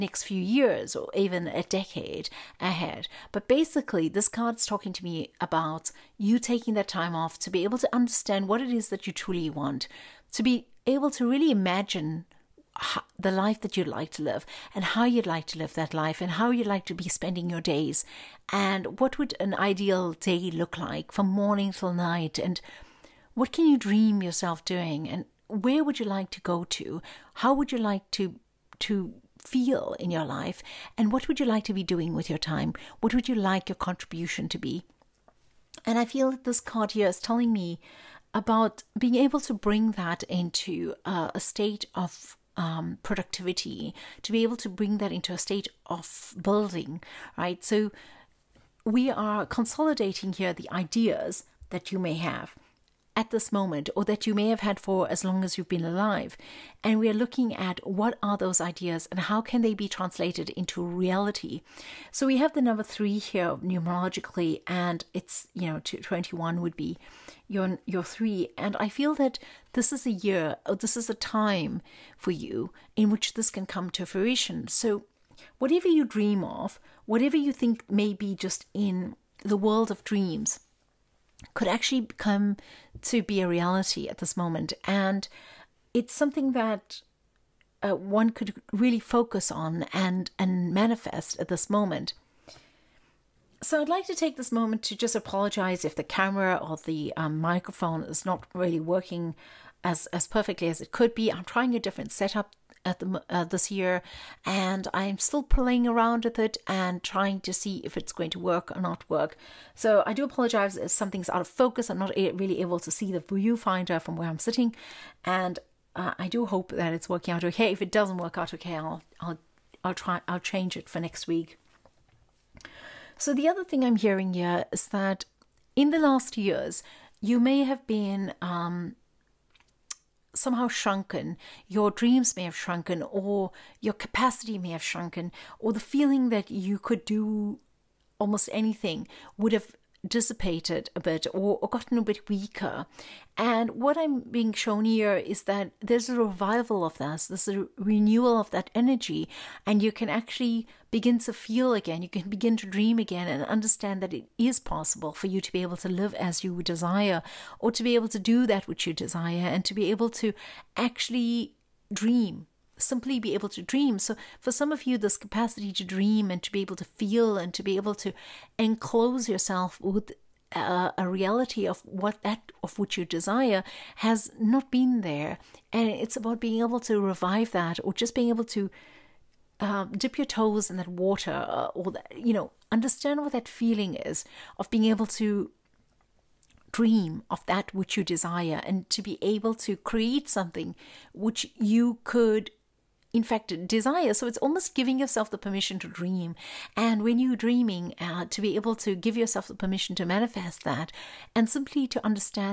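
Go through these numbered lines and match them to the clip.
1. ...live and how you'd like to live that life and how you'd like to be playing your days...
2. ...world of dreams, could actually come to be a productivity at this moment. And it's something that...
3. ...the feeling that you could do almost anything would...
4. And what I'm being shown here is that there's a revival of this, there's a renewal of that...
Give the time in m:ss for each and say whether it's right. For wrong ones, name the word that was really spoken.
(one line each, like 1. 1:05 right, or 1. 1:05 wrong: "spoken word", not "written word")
1. 0:14 wrong: "spending", not "playing"
2. 1:19 wrong: "reality", not "productivity"
3. 2:15 right
4. 2:23 right.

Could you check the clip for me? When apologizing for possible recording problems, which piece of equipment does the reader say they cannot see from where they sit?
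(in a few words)
The viewfinder.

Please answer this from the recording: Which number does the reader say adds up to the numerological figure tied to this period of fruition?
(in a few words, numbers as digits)
21.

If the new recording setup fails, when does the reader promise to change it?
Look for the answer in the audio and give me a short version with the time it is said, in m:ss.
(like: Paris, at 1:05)
Next week, at 2:00.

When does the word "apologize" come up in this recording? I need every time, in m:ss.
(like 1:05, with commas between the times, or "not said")
1:35, 1:50.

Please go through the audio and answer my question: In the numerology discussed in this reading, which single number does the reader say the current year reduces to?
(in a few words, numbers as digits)
3.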